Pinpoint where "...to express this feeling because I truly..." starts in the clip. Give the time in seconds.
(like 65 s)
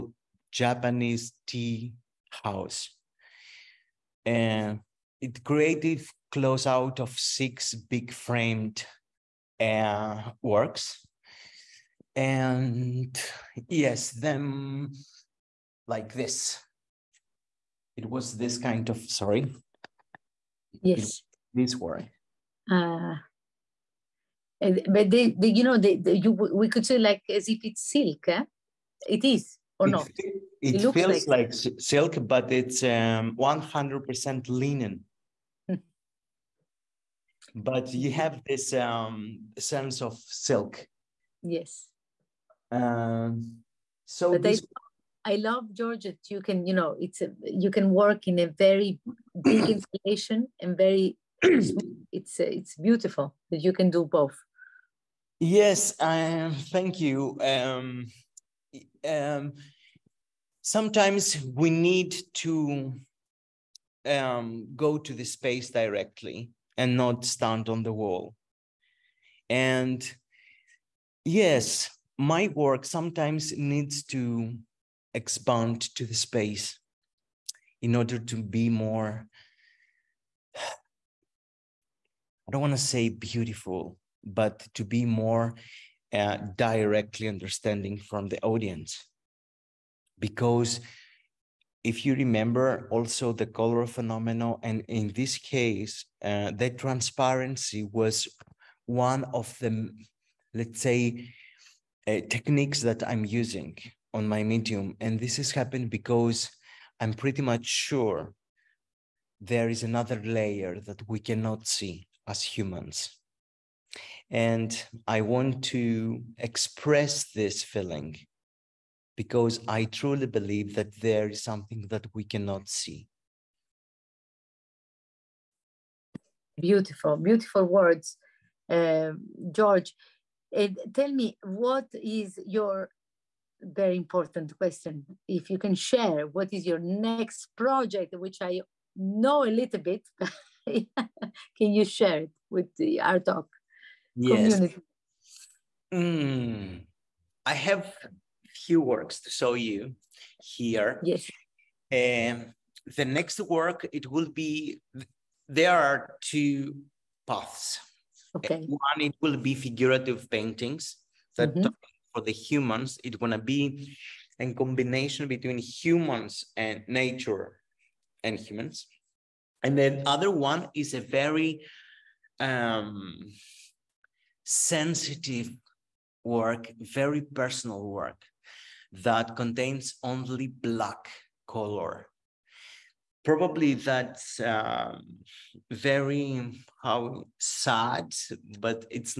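115 s.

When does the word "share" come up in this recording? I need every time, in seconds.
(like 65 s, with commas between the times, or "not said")
135 s, 141 s.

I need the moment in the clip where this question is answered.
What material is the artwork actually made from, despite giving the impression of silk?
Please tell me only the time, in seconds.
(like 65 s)
33 s.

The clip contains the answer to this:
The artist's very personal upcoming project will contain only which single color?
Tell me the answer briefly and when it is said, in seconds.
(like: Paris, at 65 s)
Black, at 180 s.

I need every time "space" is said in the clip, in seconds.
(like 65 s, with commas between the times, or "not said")
65 s, 76 s.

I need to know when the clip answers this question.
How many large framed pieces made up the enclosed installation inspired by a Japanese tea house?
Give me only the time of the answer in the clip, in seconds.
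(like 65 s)
7 s.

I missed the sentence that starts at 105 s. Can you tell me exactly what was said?
And this has happened because I'm pretty much sure there is another layer that we cannot see as humans.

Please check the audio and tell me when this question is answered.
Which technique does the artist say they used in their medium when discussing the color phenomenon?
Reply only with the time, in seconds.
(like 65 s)
96 s.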